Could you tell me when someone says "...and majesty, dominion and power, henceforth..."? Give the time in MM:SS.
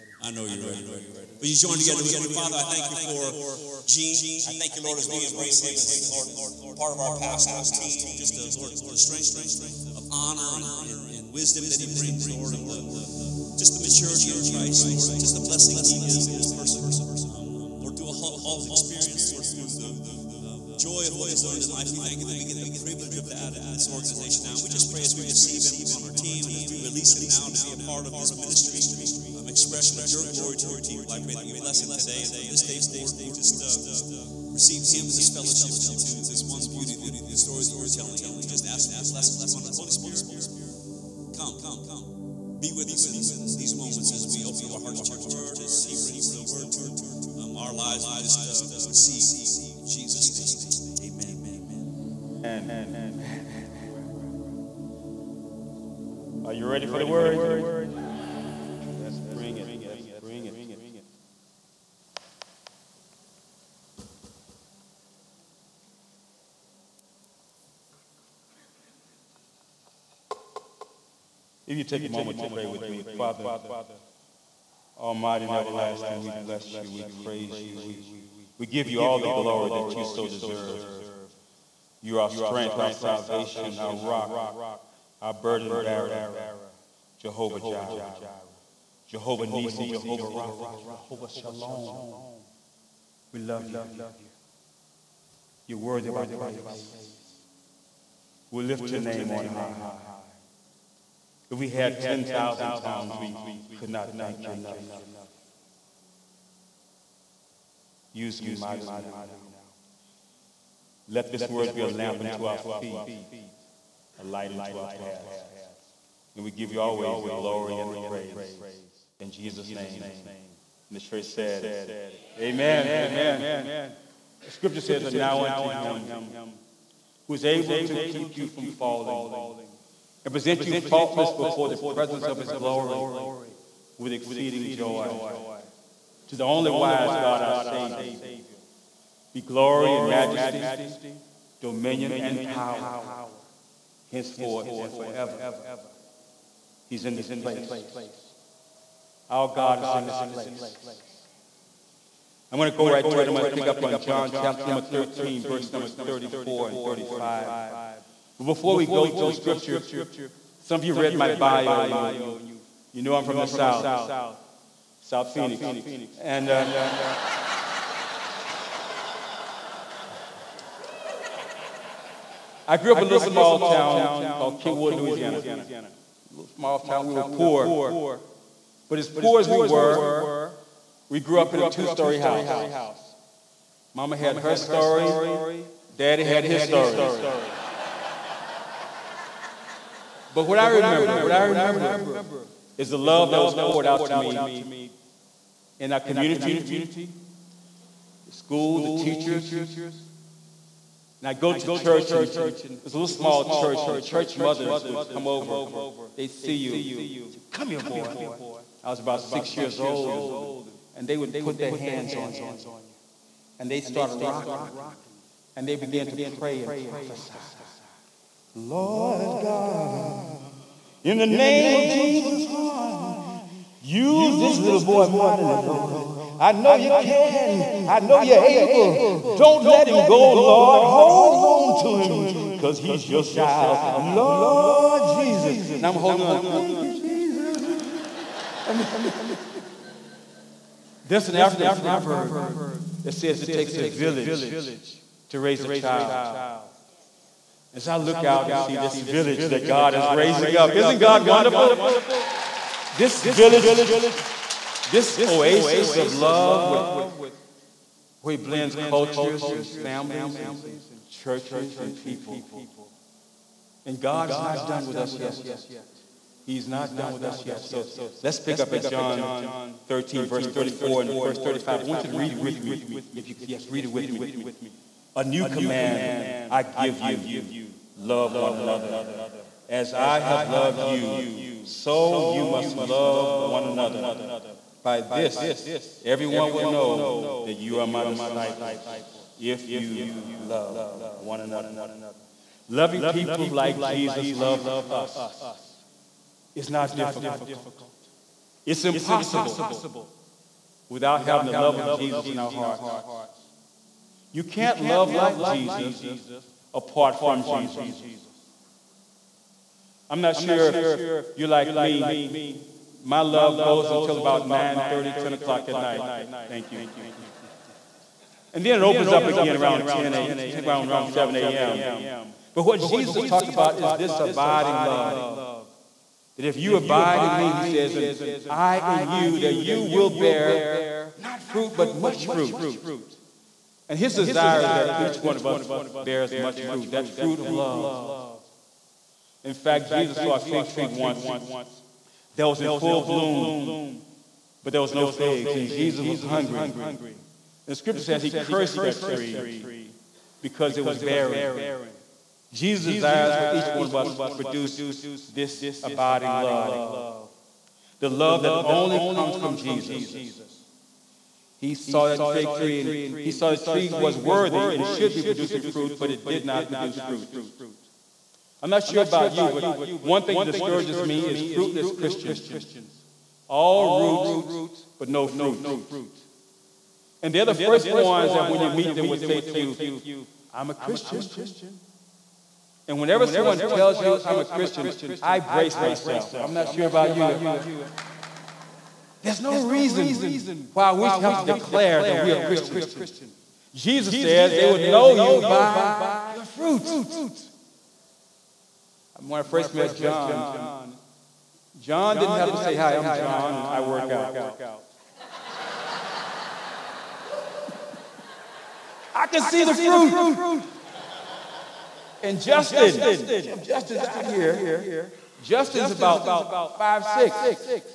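02:19.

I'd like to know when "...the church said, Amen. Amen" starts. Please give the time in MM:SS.
02:00.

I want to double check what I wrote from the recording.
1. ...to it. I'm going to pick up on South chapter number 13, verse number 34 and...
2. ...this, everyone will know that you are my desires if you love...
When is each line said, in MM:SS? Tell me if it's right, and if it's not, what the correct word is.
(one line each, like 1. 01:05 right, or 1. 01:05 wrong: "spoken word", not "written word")
1. 02:33 wrong: "John", not "South"
2. 04:45 wrong: "disciples", not "desires".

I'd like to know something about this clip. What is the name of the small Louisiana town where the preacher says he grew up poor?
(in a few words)
Kingwood.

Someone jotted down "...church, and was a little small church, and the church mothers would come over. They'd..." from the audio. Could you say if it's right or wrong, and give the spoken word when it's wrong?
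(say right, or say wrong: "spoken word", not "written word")
right.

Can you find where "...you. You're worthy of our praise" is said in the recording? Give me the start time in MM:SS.
01:33.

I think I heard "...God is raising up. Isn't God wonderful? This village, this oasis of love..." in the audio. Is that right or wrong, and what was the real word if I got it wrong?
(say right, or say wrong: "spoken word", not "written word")
right.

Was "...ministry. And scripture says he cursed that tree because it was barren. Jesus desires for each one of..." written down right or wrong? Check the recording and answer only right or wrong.
wrong.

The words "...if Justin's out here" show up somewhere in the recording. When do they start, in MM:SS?
06:53.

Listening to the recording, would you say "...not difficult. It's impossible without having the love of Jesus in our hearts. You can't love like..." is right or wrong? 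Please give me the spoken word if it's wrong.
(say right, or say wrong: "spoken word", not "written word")
right.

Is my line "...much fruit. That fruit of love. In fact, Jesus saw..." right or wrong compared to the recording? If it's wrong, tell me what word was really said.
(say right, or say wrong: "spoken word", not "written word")
right.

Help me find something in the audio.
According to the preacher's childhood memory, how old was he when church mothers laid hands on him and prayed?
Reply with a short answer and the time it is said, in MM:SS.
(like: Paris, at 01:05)
6, at 03:29.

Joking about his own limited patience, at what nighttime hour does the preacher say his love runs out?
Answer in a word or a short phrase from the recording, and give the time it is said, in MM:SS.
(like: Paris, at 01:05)
9:30, at 05:14.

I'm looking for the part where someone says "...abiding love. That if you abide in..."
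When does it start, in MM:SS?
05:24.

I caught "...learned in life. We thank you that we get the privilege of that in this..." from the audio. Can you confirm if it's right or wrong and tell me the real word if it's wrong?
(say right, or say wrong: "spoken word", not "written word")
right.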